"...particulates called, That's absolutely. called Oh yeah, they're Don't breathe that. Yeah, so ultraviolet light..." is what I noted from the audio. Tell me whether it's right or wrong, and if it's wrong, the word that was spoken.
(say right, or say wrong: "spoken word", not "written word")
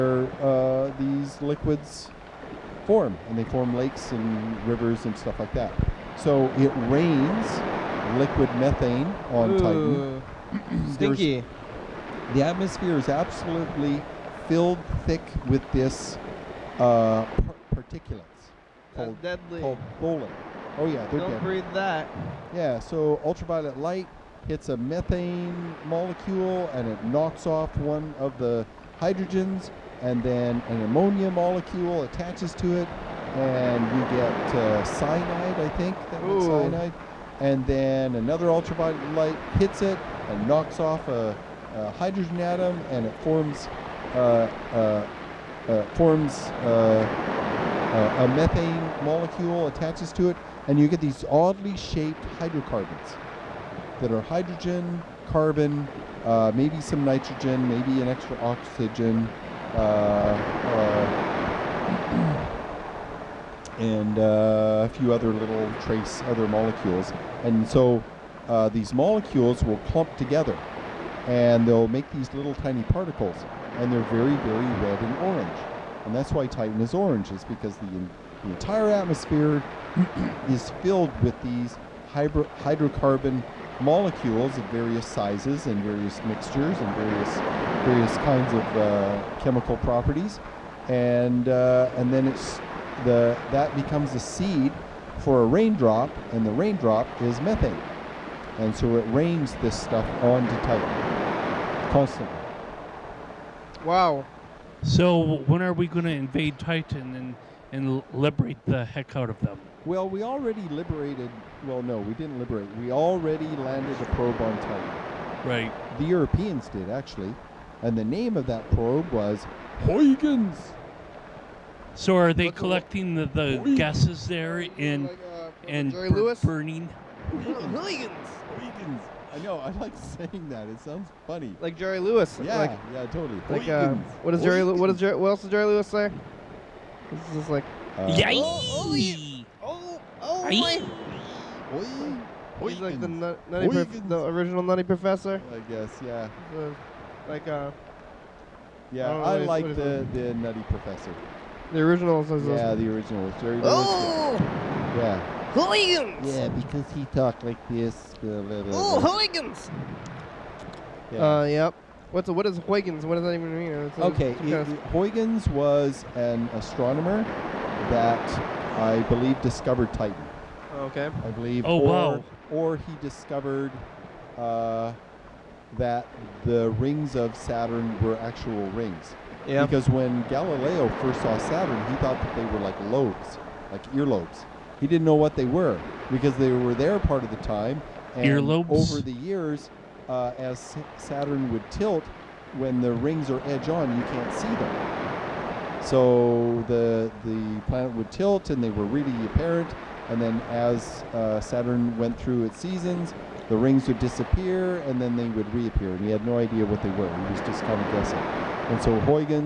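wrong: "deadly", not "absolutely".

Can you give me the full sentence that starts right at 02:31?
The original says yeah, the original.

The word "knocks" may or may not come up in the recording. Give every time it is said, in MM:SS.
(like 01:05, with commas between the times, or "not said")
00:27, 00:40.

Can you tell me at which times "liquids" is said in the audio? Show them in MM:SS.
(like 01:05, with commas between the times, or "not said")
00:01, 00:08.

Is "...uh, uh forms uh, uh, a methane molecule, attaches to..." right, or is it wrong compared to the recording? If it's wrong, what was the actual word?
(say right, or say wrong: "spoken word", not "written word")
right.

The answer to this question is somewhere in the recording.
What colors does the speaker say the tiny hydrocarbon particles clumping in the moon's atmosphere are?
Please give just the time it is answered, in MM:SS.
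01:14.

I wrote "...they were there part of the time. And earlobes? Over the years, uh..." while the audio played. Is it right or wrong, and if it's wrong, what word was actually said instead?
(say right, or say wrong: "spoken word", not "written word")
right.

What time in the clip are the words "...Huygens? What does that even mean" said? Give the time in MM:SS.
02:42.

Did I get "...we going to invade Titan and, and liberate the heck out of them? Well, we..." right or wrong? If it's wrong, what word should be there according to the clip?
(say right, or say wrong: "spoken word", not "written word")
right.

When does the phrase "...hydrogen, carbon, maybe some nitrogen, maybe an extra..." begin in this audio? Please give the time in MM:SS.
00:54.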